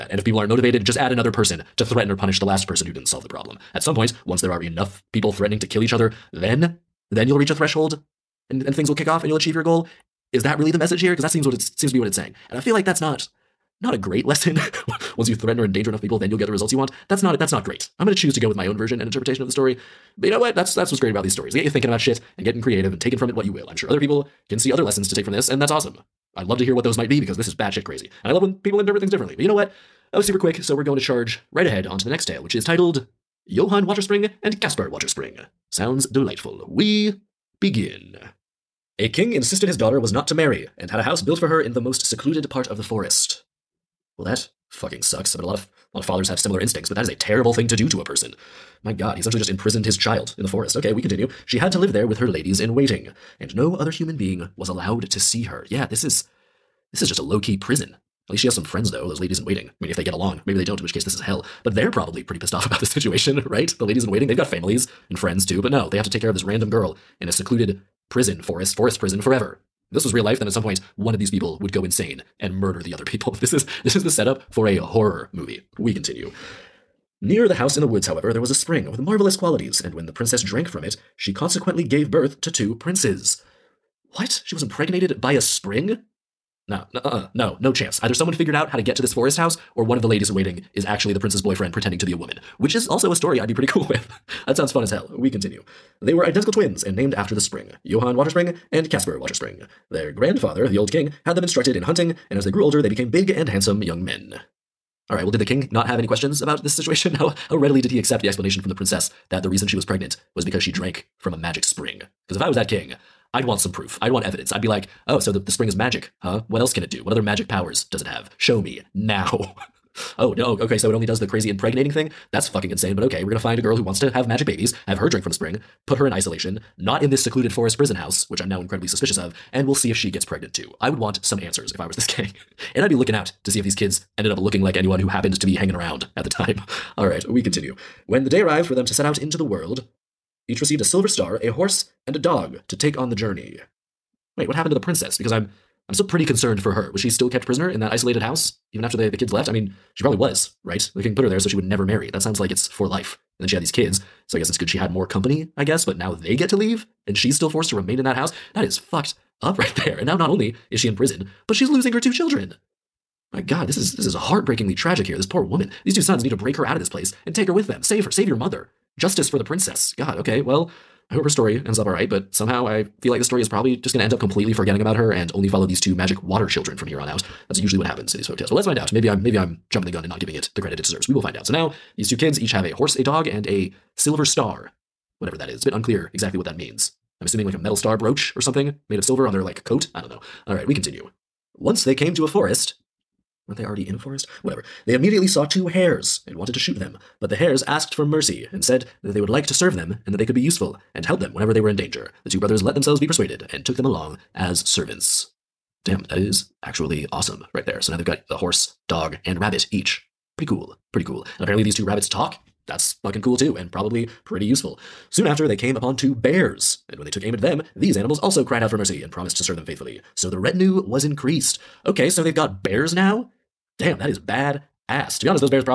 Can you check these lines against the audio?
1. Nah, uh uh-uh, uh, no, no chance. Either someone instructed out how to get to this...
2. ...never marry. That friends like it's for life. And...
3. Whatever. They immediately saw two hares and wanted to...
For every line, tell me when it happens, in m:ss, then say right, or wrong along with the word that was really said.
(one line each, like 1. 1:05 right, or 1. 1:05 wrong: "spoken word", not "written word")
1. 1:26 wrong: "figured", not "instructed"
2. 2:31 wrong: "sounds", not "friends"
3. 3:14 right.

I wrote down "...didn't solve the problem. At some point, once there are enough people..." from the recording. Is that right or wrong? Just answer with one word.
right.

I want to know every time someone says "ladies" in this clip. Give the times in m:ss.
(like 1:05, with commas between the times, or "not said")
0:52, 0:59, 1:03, 1:30.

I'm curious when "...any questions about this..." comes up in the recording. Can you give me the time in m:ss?
1:45.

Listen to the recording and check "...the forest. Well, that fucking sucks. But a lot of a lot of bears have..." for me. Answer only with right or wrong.
wrong.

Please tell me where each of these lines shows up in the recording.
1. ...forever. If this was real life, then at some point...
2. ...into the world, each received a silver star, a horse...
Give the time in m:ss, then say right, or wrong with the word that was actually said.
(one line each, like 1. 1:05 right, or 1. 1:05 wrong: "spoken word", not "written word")
1. 1:09 right
2. 2:19 right.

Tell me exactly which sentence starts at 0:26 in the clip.
I'd love to hear what those might be because this is batshit crazy.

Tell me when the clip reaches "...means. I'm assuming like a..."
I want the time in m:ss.
3:06.